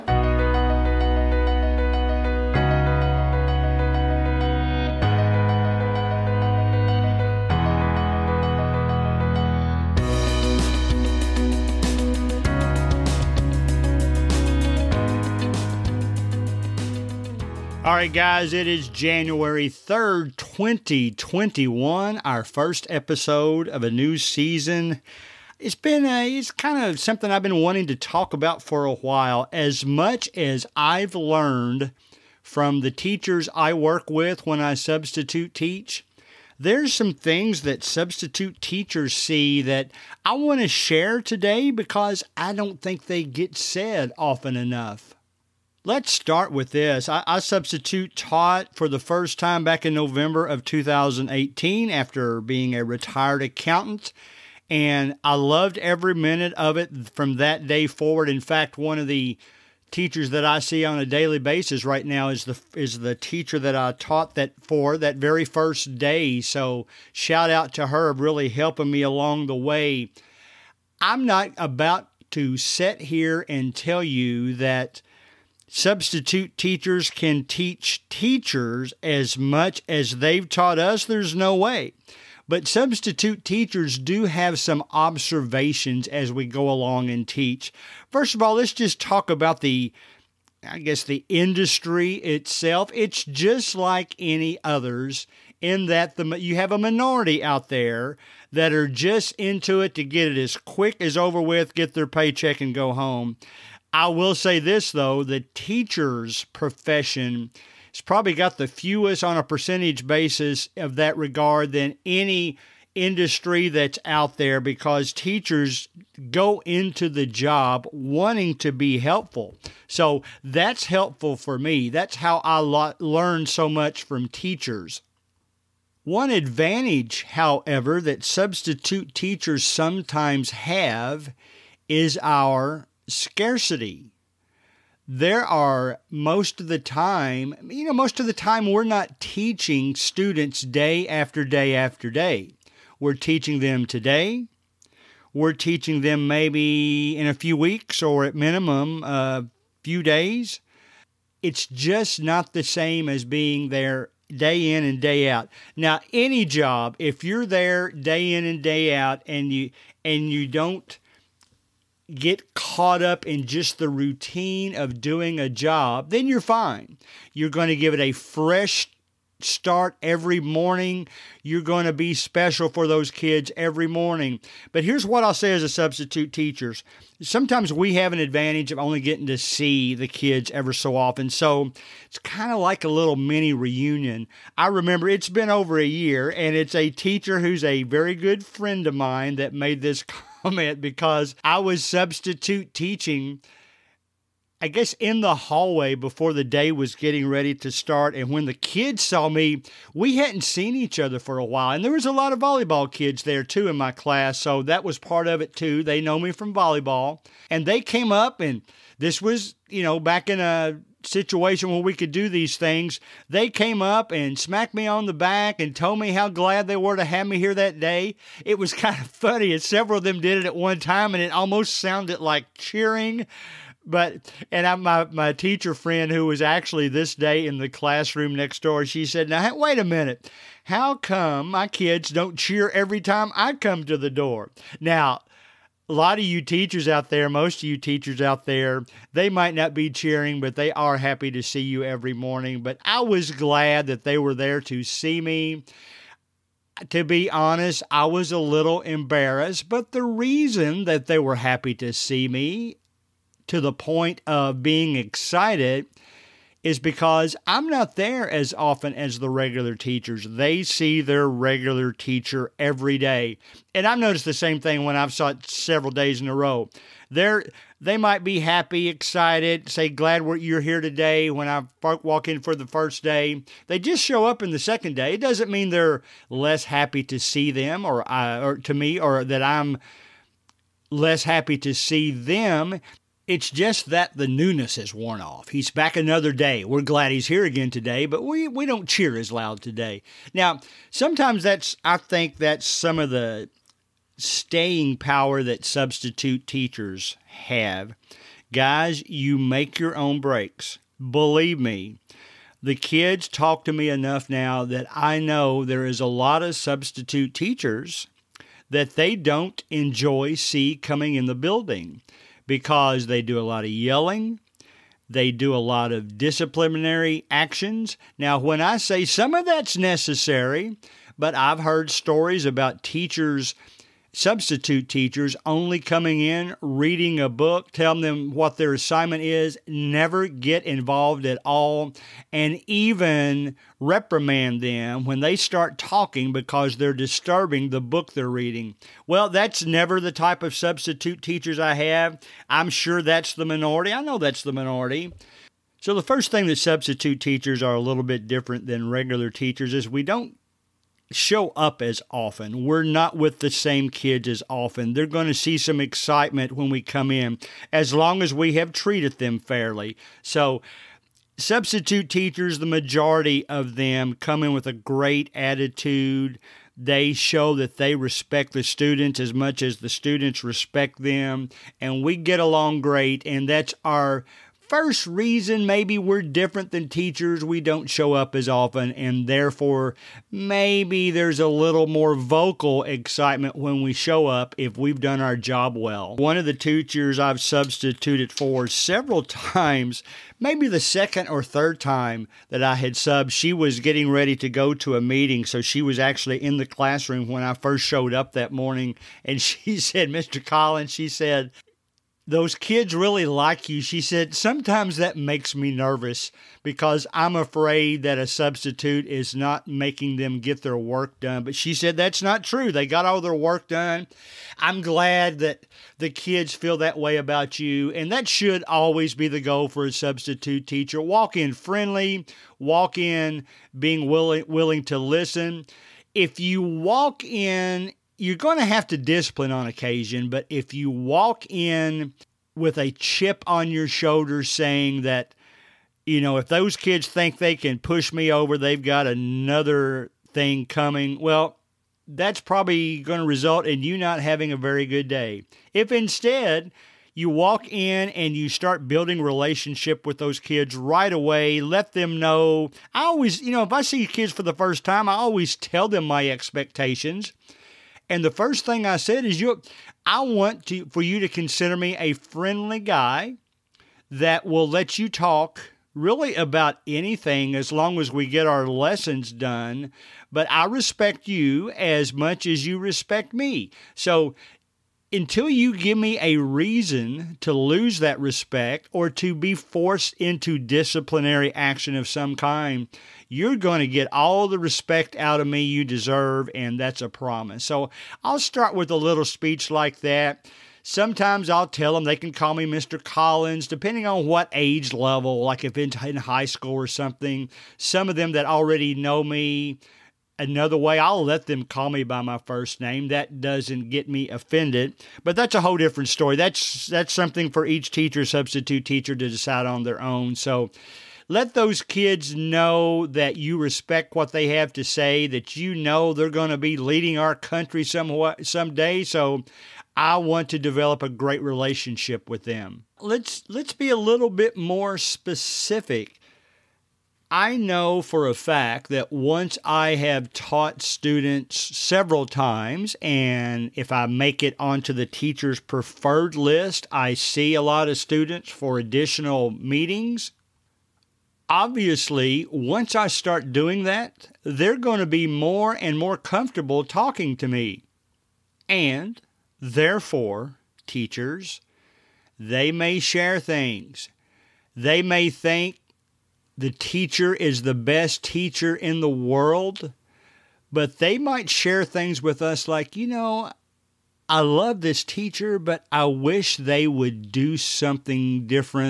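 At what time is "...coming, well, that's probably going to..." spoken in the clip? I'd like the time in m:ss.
7:20.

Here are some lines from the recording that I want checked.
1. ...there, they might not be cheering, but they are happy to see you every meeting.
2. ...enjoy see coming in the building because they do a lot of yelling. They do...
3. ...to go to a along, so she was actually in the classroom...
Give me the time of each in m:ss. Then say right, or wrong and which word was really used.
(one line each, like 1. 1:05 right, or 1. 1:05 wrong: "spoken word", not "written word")
1. 3:58 wrong: "morning", not "meeting"
2. 5:09 right
3. 6:34 wrong: "meeting", not "along".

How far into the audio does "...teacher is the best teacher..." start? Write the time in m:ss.
9:16.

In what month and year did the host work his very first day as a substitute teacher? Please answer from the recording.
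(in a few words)
November 2018.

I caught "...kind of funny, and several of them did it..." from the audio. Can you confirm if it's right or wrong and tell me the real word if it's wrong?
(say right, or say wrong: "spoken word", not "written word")
right.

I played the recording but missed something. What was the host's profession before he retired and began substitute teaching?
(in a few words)
Accountant.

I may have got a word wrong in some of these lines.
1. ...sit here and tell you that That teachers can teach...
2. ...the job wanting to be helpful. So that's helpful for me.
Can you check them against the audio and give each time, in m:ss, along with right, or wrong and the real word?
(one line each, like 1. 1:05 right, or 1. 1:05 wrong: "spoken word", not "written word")
1. 1:12 wrong: "Substitute", not "That"
2. 1:57 right.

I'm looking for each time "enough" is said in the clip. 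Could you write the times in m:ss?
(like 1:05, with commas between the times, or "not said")
0:44, 5:03.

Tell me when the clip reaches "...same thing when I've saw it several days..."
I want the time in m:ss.
4:24.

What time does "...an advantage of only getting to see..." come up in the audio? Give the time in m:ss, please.
2:58.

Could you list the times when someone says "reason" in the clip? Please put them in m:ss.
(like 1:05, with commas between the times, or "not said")
4:10, 6:15, 7:56.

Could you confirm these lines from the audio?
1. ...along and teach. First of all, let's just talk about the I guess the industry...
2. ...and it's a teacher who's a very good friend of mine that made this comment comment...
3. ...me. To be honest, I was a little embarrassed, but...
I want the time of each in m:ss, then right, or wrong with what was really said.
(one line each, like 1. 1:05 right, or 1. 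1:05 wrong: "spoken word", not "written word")
1. 1:26 right
2. 3:06 right
3. 4:05 right.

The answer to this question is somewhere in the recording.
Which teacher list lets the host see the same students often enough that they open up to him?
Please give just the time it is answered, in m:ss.
8:55.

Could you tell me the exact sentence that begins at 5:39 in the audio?
Well, that's never the type of substitute teachers I have.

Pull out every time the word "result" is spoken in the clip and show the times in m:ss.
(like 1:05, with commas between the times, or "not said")
7:23.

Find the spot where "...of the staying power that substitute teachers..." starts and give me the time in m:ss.
4:52.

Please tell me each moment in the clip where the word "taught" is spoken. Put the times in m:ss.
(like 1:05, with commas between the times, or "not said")
0:48, 1:03, 1:20, 8:50.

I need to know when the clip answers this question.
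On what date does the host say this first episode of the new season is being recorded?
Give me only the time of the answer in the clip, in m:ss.
0:18.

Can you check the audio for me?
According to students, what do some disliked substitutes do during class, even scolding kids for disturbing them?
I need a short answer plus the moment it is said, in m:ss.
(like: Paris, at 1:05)
Reading a book, at 5:26.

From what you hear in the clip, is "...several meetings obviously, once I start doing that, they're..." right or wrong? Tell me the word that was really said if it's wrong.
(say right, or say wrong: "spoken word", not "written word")
wrong: "additional", not "several".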